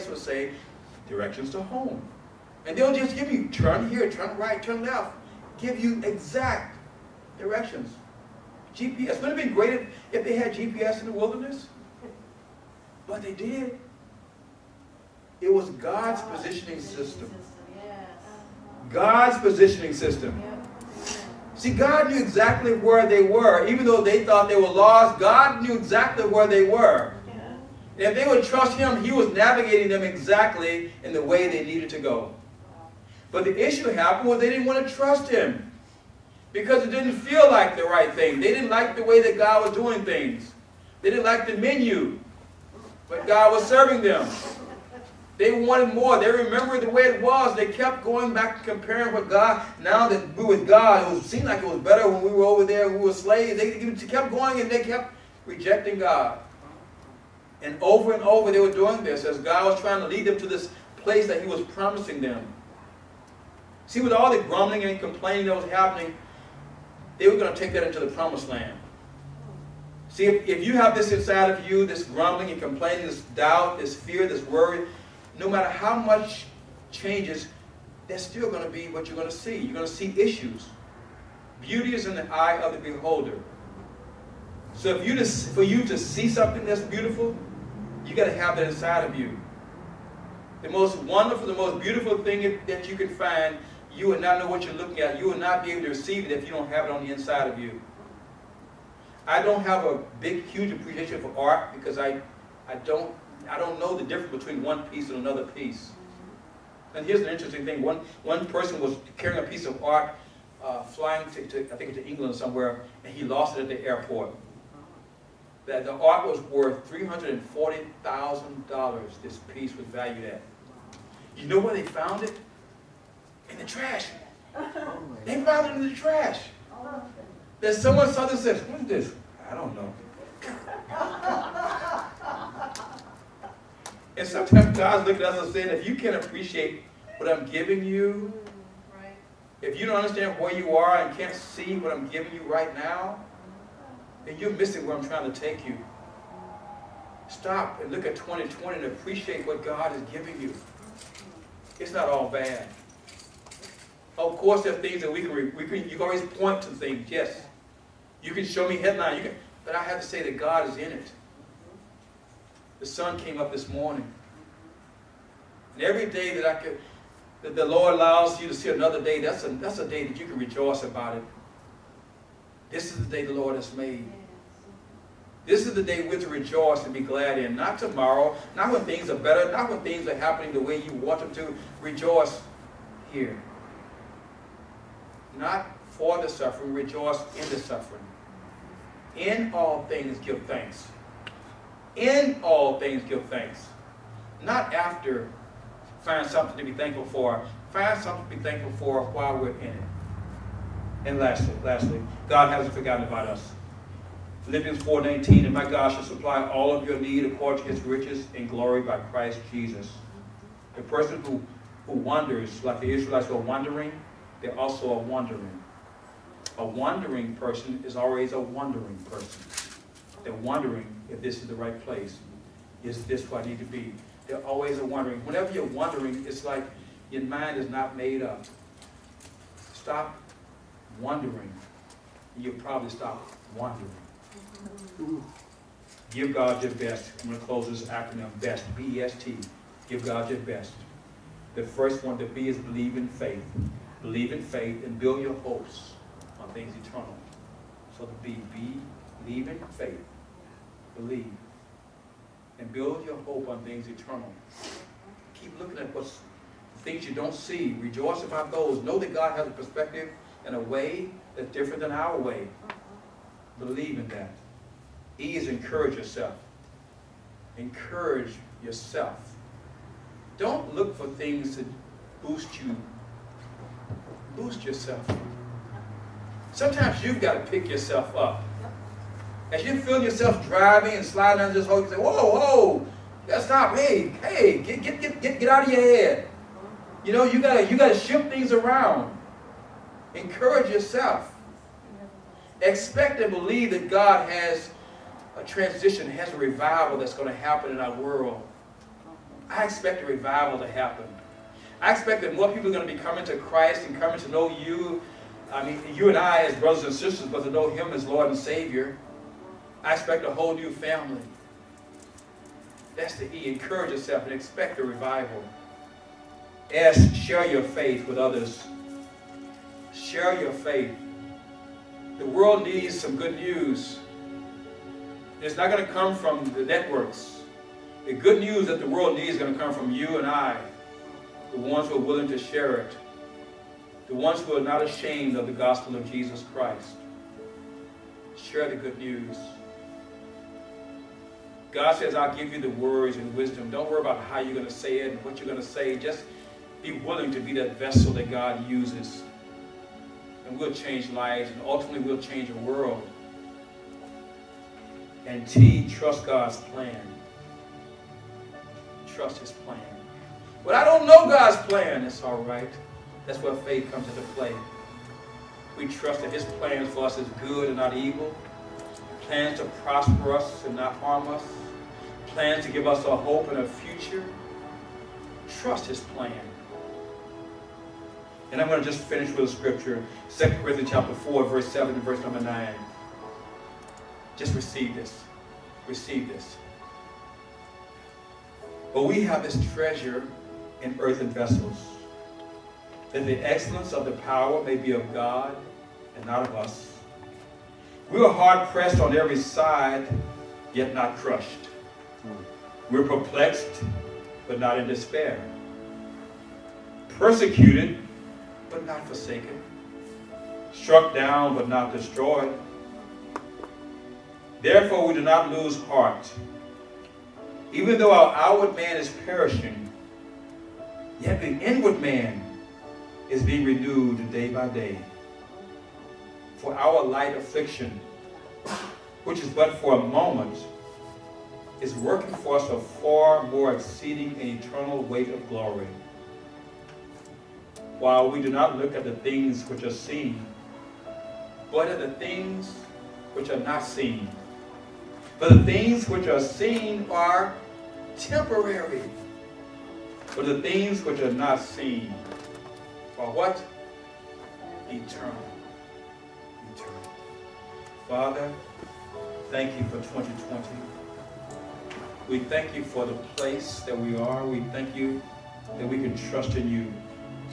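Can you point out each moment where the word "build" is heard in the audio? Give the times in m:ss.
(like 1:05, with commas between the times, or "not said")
4:04, 4:12.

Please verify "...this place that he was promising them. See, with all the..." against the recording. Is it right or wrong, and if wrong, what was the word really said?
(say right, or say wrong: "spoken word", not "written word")
right.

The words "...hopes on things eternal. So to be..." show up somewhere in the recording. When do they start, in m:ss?
4:05.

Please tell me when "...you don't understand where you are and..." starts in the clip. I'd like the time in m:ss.
2:19.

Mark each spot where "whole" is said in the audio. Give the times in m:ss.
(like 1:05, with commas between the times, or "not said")
5:10.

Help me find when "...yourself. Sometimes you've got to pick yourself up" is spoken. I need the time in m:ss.
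4:34.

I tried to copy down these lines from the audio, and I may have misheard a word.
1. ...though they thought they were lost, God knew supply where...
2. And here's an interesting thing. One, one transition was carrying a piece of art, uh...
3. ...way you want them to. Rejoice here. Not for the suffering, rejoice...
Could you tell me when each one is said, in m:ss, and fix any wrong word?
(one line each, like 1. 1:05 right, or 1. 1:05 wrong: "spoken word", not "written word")
1. 0:23 wrong: "exactly", not "supply"
2. 1:46 wrong: "person", not "transition"
3. 3:00 right.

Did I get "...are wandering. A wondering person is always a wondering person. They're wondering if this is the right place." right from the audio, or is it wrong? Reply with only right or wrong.
right.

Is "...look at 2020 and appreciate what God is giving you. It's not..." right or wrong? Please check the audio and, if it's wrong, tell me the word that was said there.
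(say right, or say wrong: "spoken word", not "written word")
right.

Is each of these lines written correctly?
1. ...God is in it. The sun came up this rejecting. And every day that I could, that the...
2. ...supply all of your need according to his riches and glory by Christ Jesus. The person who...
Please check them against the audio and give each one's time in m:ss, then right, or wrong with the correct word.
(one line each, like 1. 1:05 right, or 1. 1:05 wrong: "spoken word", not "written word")
1. 2:40 wrong: "morning", not "rejecting"
2. 3:26 right.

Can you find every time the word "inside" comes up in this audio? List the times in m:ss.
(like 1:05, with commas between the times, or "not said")
1:11, 1:28, 1:37.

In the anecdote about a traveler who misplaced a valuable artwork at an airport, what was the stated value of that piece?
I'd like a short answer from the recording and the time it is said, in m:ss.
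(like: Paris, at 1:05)
$340,000, at 1:56.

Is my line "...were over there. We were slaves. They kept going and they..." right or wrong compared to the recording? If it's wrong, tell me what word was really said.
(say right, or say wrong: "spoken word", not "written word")
right.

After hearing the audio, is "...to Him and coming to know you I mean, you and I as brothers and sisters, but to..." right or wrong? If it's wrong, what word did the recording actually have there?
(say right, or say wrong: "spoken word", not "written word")
wrong: "Christ", not "Him".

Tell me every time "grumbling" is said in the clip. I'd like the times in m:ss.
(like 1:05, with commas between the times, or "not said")
1:04, 1:12.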